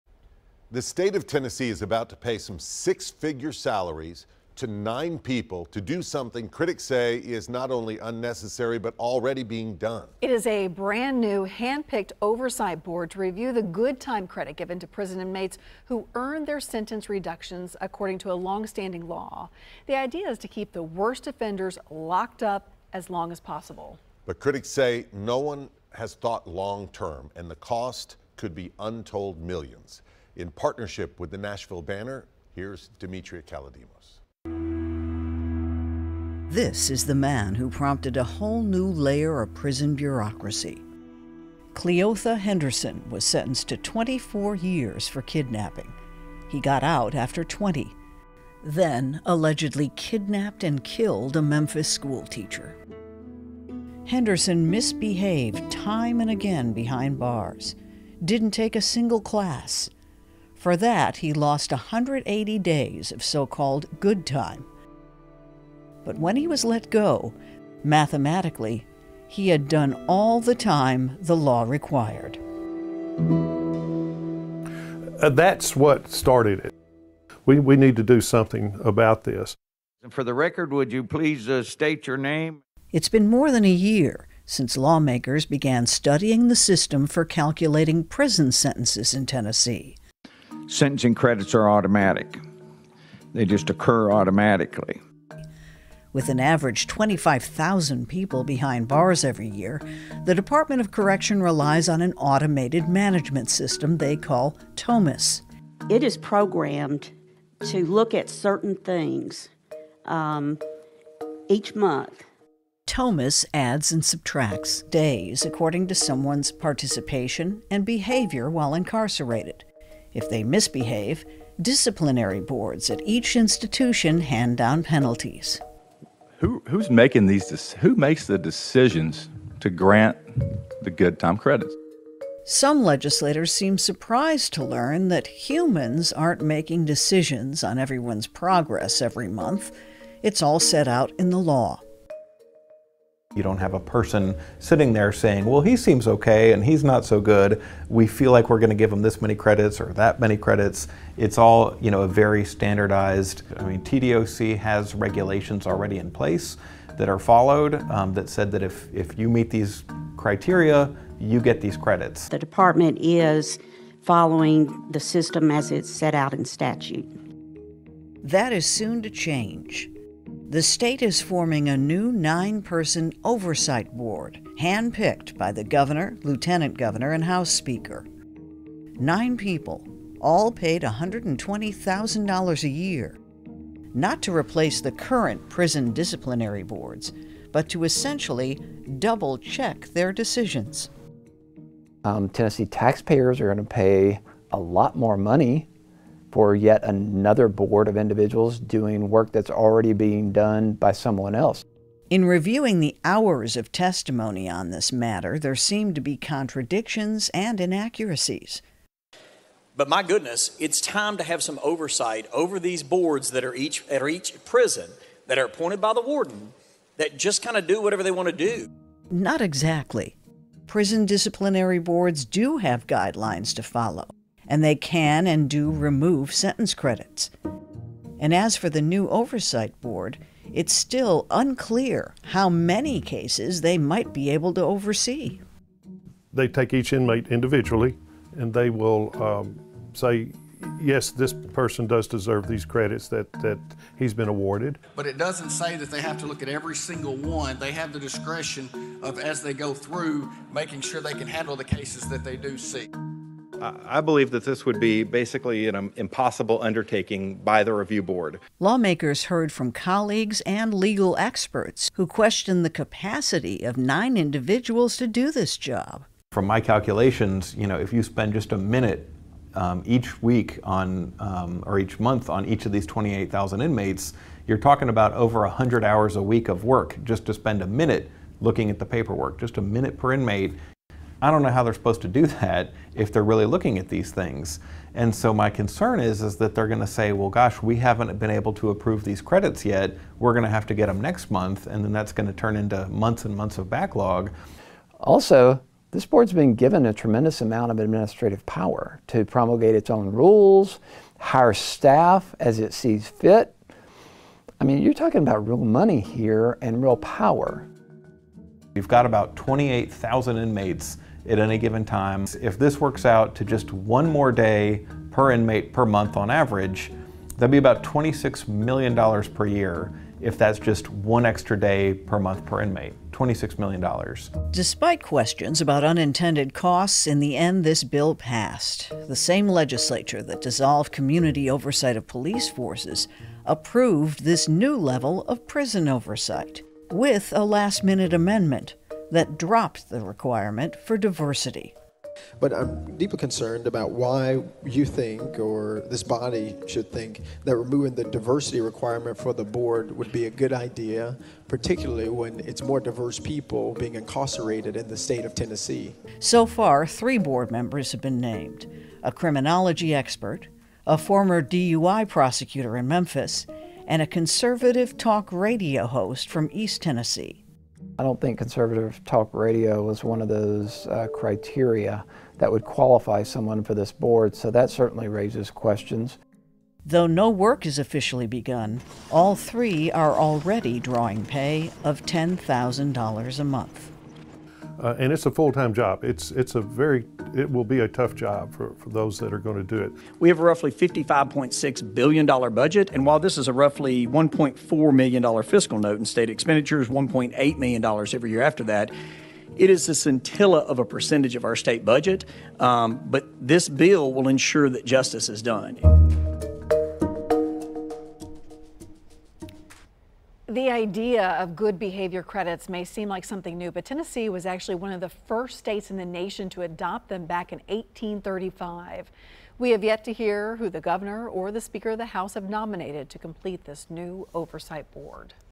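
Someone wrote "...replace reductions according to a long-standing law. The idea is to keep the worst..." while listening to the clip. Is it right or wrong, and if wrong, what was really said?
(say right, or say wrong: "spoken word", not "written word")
wrong: "sentence", not "replace".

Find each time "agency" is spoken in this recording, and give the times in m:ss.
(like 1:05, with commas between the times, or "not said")
not said.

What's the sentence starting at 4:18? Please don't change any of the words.
Lawmakers heard from colleagues and legal experts who questioned the capacity of nine individuals to do this job.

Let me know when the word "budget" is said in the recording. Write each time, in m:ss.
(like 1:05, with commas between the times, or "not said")
6:32, 6:41.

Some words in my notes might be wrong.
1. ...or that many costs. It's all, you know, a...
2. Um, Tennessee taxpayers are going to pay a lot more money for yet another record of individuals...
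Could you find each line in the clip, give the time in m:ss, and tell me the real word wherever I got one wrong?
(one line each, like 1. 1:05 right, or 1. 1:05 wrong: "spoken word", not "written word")
1. 2:29 wrong: "credits", not "costs"
2. 3:12 wrong: "board", not "record".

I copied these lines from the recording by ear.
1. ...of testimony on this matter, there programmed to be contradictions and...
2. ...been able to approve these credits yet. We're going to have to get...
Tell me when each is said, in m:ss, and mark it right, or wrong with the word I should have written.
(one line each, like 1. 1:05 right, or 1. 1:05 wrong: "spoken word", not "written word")
1. 3:23 wrong: "seemed", not "programmed"
2. 4:48 right.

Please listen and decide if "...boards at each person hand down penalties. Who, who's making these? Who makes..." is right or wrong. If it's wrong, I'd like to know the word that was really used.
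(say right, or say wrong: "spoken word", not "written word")
wrong: "institution", not "person".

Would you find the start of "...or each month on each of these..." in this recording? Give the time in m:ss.
4:31.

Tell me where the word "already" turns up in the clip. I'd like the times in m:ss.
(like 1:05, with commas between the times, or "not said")
0:08, 2:35, 3:19, 6:20.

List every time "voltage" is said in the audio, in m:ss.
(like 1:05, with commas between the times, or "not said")
not said.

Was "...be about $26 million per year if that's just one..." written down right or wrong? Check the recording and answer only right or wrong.
right.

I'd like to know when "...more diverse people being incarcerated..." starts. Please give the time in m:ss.
5:52.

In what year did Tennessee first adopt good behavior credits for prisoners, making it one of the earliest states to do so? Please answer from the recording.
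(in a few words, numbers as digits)
1835.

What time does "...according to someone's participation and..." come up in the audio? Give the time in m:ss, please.
1:55.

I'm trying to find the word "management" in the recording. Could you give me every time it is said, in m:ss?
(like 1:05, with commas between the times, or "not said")
1:42.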